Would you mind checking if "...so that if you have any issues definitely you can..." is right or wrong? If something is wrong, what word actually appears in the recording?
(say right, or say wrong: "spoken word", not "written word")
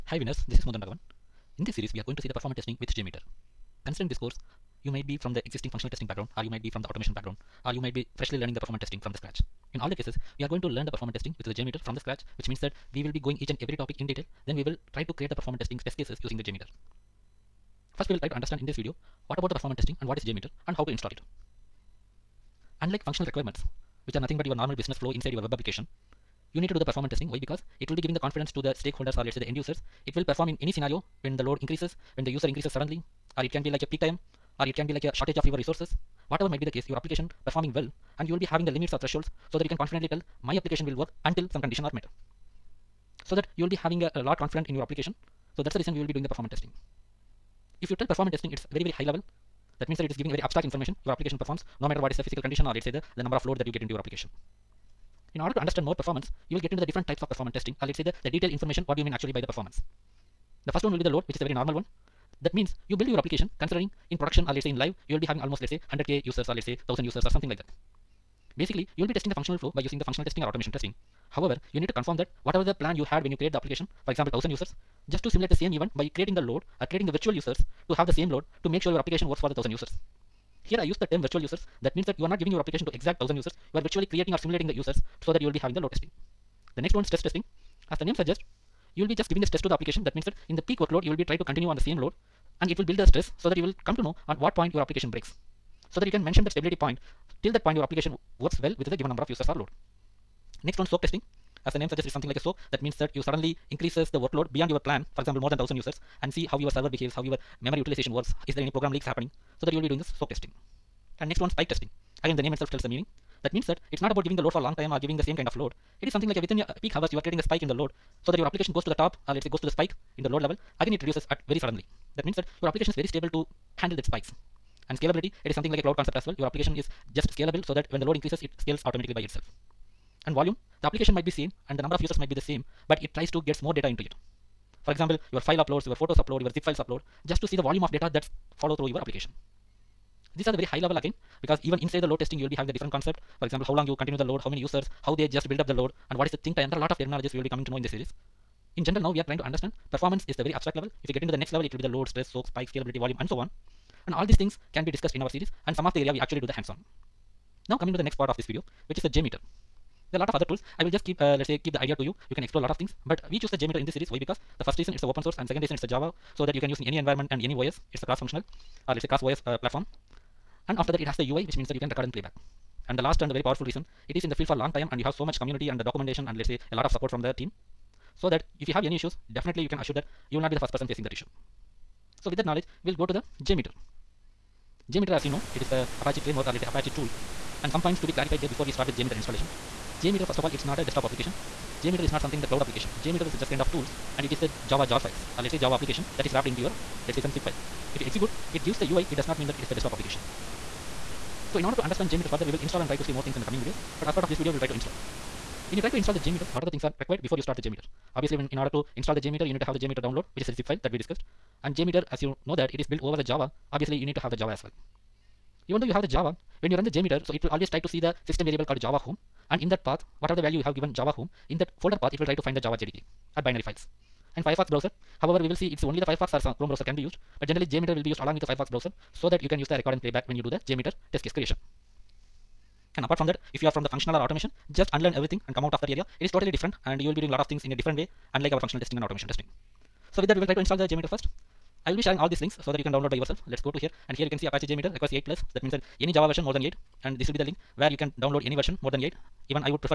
right.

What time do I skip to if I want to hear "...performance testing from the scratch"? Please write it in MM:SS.
00:08.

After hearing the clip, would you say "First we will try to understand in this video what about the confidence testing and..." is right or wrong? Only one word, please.
wrong.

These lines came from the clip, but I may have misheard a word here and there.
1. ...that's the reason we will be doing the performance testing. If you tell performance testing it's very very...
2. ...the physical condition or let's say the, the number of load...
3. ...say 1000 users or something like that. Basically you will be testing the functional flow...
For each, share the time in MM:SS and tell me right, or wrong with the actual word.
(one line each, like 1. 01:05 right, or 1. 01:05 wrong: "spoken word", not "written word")
1. 00:45 right
2. 00:52 right
3. 01:06 right.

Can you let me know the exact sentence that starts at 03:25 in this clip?
When you try to install the JMeter, what are the things are required before you start the JMeter?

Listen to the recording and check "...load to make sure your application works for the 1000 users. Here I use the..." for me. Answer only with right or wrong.
right.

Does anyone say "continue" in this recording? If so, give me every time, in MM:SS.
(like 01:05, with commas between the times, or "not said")
01:31, 02:24.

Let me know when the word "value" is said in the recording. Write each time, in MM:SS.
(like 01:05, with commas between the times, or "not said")
03:40.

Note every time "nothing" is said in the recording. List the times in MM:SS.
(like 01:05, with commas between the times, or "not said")
00:24.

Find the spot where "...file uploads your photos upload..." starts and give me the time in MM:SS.
02:15.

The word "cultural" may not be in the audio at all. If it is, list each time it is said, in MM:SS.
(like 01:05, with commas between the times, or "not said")
not said.